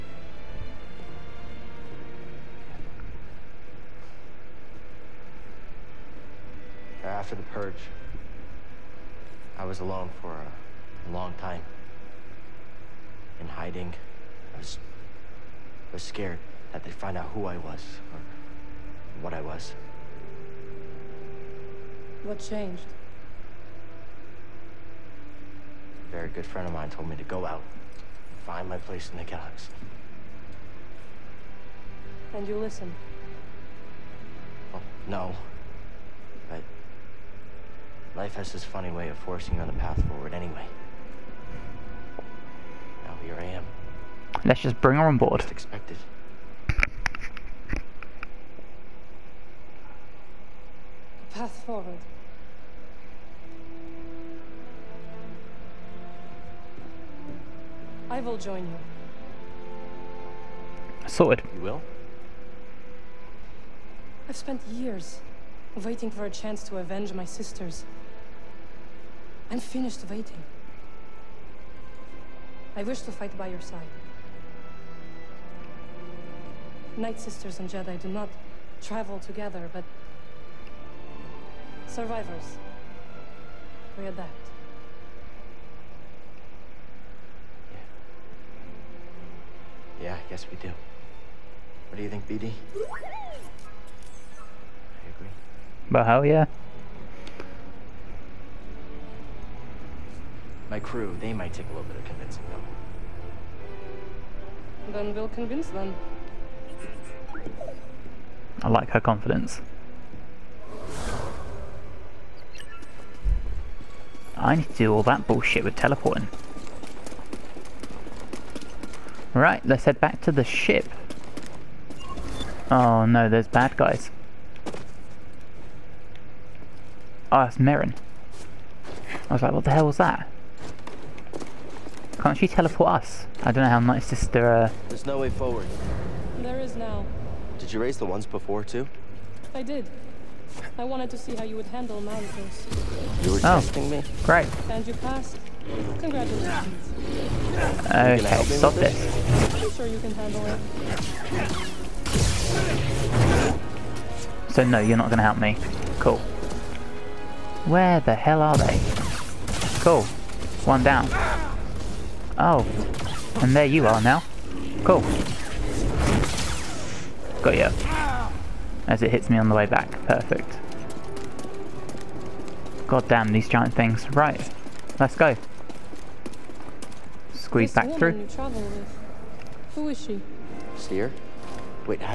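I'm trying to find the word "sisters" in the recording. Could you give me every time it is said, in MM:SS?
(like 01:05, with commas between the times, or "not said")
01:07, 01:17.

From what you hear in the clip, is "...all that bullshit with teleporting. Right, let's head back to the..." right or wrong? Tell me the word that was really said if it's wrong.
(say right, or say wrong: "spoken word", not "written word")
right.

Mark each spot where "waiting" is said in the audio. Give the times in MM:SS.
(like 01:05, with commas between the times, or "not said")
01:05, 01:10.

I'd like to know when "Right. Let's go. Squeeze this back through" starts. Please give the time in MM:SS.
02:54.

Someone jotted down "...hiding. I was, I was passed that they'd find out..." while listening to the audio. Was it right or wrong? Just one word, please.
wrong.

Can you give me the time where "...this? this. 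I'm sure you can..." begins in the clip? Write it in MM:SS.
02:28.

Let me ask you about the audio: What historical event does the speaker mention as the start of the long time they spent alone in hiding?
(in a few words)
the Purge.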